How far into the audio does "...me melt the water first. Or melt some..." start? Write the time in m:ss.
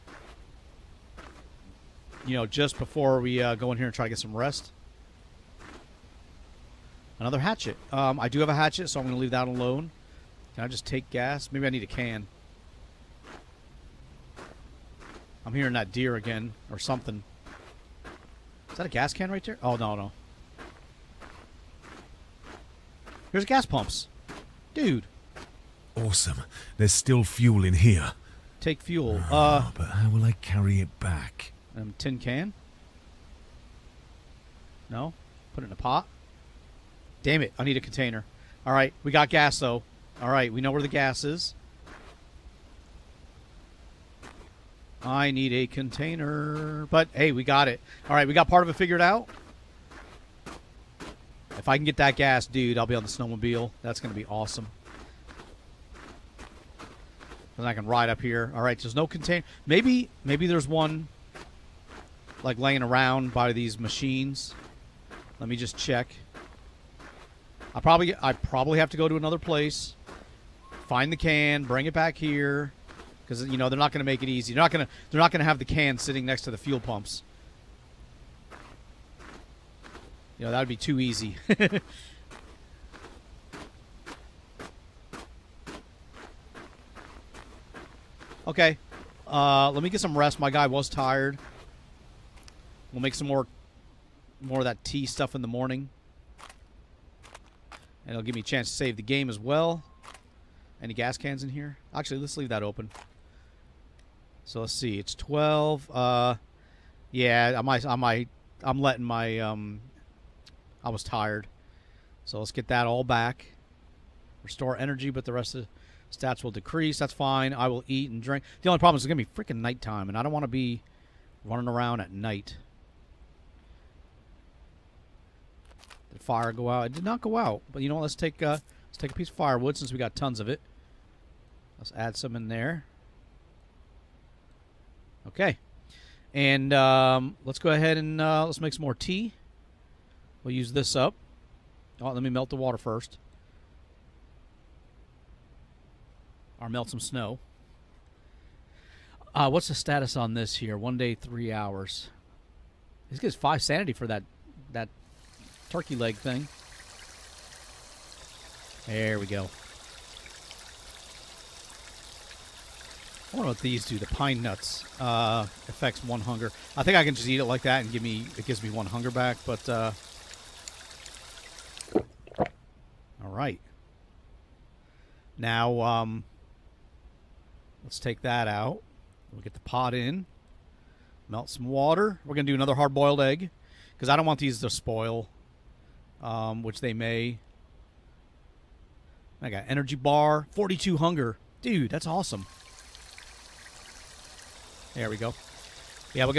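2:22.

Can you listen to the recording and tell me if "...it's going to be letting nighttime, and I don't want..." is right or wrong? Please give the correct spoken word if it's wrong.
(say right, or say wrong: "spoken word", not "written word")
wrong: "freaking", not "letting".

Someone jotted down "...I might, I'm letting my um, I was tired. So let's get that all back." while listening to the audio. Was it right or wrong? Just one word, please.
right.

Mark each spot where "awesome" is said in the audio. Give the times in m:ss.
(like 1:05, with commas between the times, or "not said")
0:25, 0:54, 3:12.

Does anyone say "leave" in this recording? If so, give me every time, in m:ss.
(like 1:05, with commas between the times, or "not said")
0:09, 1:42.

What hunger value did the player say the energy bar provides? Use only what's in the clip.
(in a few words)
42.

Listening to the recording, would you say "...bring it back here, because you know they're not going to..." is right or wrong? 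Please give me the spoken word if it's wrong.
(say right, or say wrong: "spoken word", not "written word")
right.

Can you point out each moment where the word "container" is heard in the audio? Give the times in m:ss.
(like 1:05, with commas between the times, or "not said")
0:37, 0:45, 0:59.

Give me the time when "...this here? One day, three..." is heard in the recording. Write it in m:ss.
2:30.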